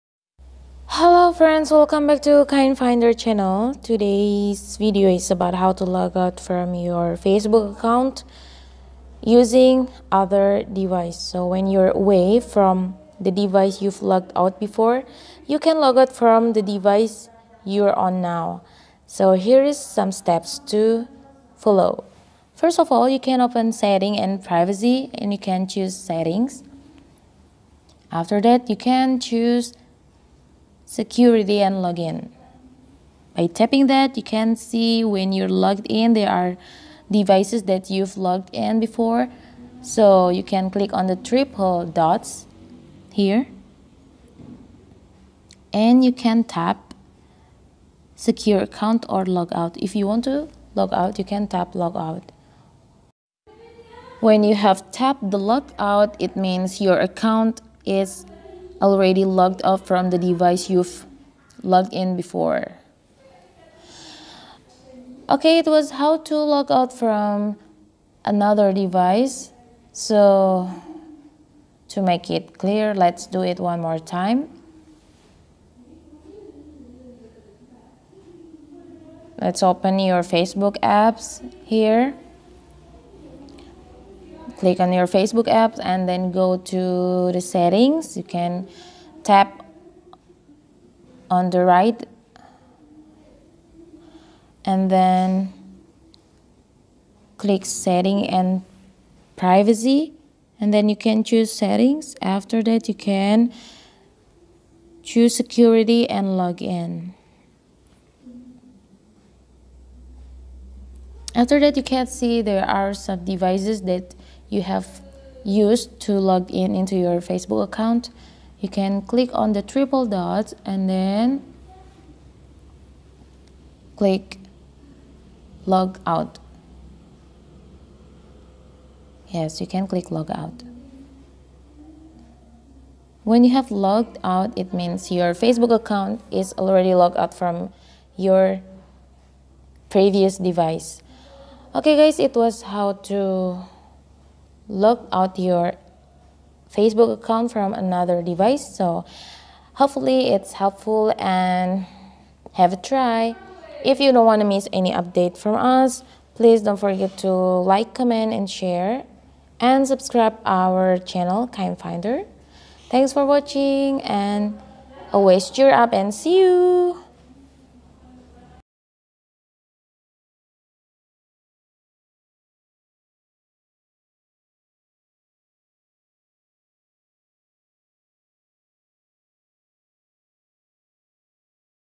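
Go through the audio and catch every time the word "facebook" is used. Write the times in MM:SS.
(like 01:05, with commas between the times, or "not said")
00:07, 01:20, 01:25, 01:57, 02:15, 02:26.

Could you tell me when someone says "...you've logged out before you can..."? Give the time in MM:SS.
00:13.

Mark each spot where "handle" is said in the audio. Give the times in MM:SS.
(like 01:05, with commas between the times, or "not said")
not said.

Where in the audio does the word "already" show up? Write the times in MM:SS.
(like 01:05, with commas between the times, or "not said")
00:58, 02:16.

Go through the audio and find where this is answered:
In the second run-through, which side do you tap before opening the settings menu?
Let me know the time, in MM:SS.
01:31.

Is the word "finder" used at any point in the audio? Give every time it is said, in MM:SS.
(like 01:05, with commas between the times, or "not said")
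00:02, 02:41.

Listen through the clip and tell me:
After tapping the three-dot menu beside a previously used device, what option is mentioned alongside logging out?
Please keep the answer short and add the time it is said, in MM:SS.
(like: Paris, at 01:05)
Secure account, at 00:48.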